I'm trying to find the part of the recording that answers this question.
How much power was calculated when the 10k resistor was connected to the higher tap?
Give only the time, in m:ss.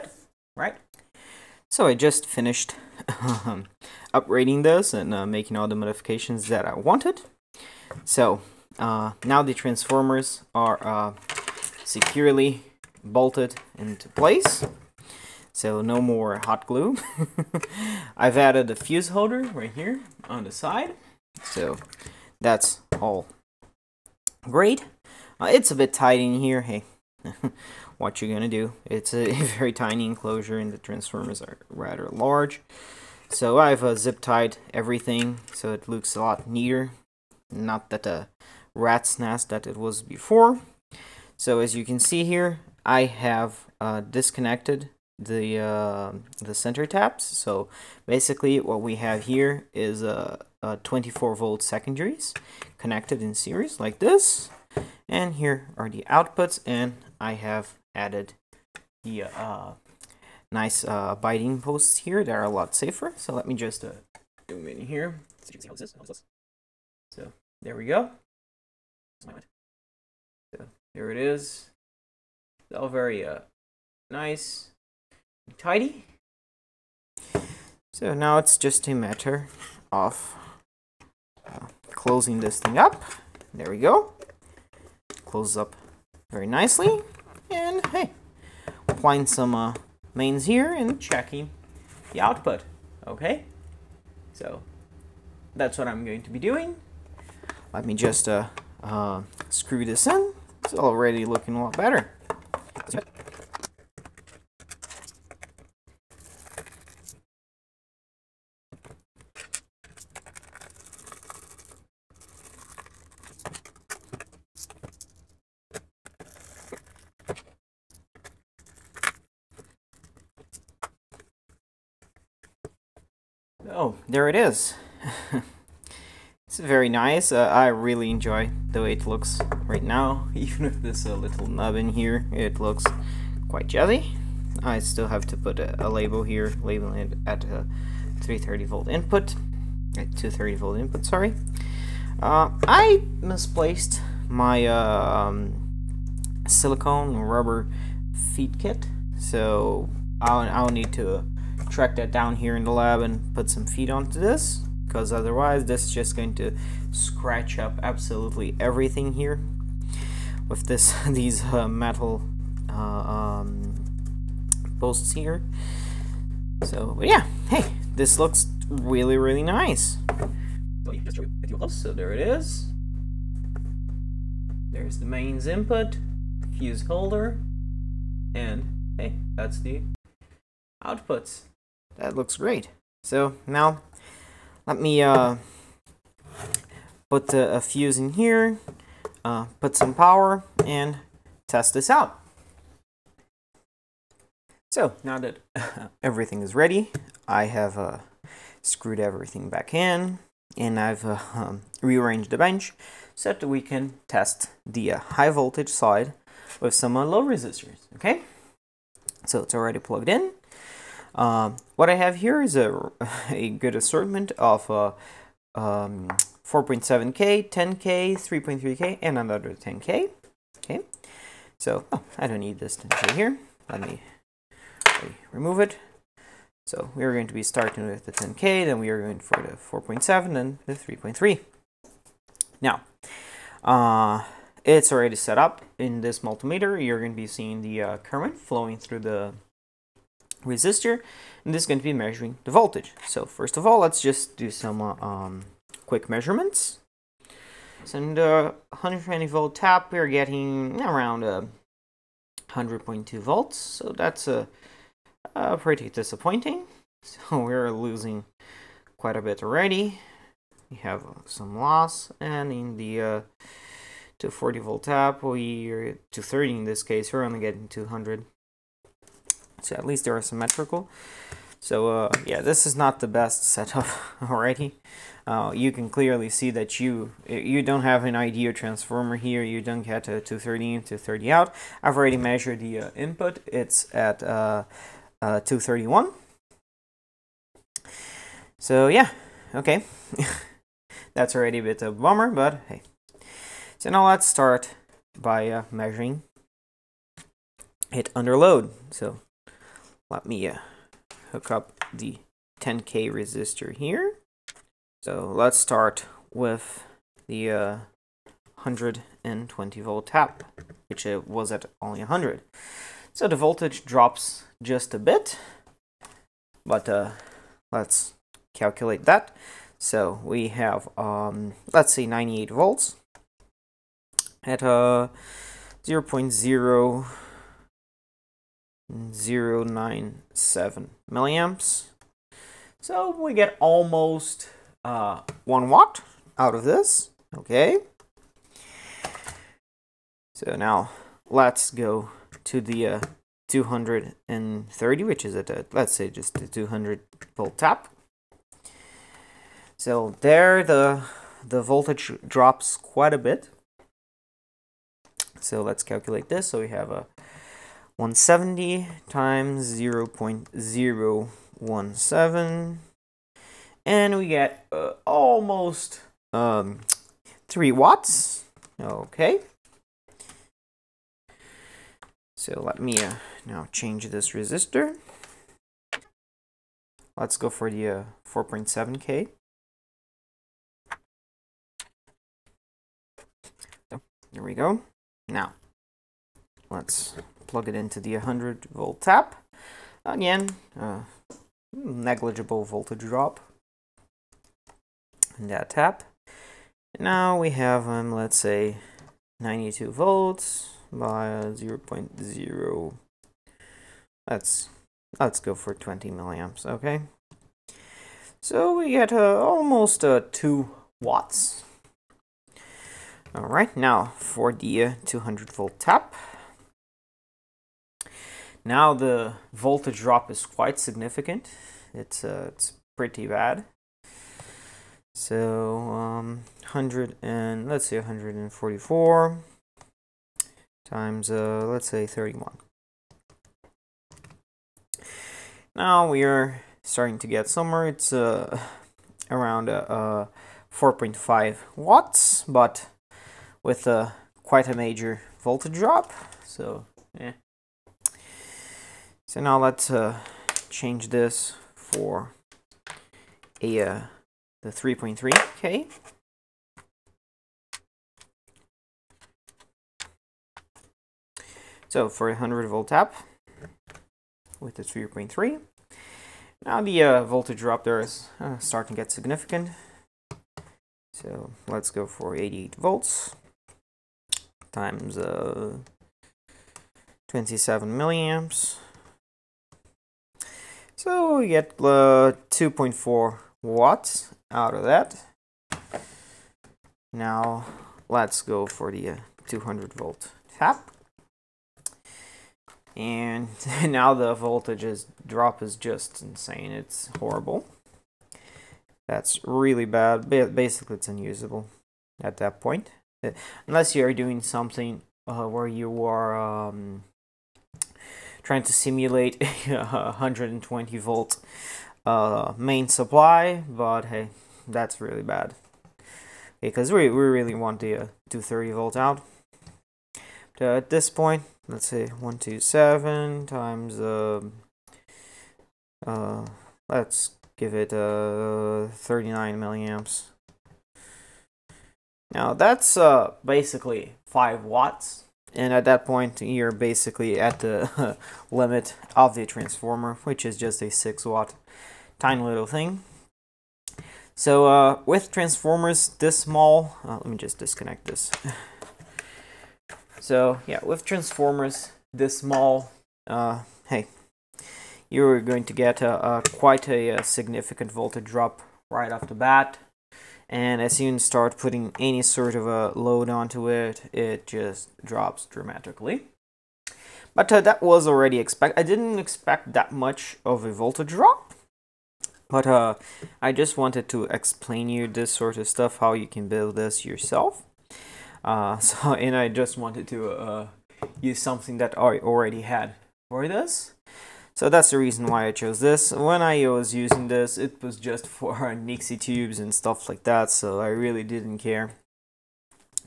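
6:07.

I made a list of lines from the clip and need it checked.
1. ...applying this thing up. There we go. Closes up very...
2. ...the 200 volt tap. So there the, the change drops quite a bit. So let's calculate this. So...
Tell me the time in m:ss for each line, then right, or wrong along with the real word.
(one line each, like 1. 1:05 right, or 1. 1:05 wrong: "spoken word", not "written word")
1. 1:21 wrong: "closing", not "applying"
2. 5:46 wrong: "voltage", not "change".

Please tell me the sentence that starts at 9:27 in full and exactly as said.
But uh, that was already expect.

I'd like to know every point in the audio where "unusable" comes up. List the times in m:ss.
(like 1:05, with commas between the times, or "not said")
8:21.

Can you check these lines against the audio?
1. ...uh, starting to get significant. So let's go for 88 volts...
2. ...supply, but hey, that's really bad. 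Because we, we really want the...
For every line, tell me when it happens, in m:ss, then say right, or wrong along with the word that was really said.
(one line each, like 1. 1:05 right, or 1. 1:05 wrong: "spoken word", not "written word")
1. 7:48 right
2. 8:32 right.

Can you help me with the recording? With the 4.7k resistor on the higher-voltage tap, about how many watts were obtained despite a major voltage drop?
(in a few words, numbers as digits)
about 4.5 watts.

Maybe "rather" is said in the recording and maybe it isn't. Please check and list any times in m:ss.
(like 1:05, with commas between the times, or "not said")
0:31.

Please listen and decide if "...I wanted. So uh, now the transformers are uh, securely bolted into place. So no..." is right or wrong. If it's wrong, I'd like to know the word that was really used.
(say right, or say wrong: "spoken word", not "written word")
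right.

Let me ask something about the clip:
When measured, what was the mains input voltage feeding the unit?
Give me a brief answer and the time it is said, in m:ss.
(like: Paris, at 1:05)
231 volts, at 4:45.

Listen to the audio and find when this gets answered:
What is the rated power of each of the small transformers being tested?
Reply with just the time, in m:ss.
9:00.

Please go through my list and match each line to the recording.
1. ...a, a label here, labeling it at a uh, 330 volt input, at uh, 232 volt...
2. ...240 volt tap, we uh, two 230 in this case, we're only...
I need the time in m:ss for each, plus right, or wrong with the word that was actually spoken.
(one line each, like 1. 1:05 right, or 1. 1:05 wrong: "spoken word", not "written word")
1. 2:15 wrong: "230", not "232"
2. 4:24 right.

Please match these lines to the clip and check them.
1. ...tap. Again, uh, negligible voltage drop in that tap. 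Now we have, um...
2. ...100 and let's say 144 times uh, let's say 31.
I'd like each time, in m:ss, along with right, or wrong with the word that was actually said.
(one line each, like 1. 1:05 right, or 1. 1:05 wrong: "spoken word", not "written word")
1. 6:29 right
2. 7:06 right.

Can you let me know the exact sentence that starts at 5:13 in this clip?
So the voltage drops just a bit, but uh, let's calculate that.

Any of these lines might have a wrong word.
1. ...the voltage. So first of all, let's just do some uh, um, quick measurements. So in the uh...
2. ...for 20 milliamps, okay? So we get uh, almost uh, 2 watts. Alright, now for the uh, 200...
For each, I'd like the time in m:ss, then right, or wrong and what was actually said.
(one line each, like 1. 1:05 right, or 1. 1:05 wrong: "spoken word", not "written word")
1. 4:02 right
2. 6:45 right.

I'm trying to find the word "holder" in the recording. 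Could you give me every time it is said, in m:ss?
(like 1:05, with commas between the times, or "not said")
0:19, 2:56.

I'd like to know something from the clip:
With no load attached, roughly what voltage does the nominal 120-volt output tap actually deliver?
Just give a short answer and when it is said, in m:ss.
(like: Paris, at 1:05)
100.2 volts, at 4:12.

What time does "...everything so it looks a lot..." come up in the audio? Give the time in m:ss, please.
0:34.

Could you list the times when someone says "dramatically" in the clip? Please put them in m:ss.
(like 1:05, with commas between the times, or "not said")
9:25.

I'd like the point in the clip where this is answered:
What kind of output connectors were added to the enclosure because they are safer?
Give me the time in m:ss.
1:01.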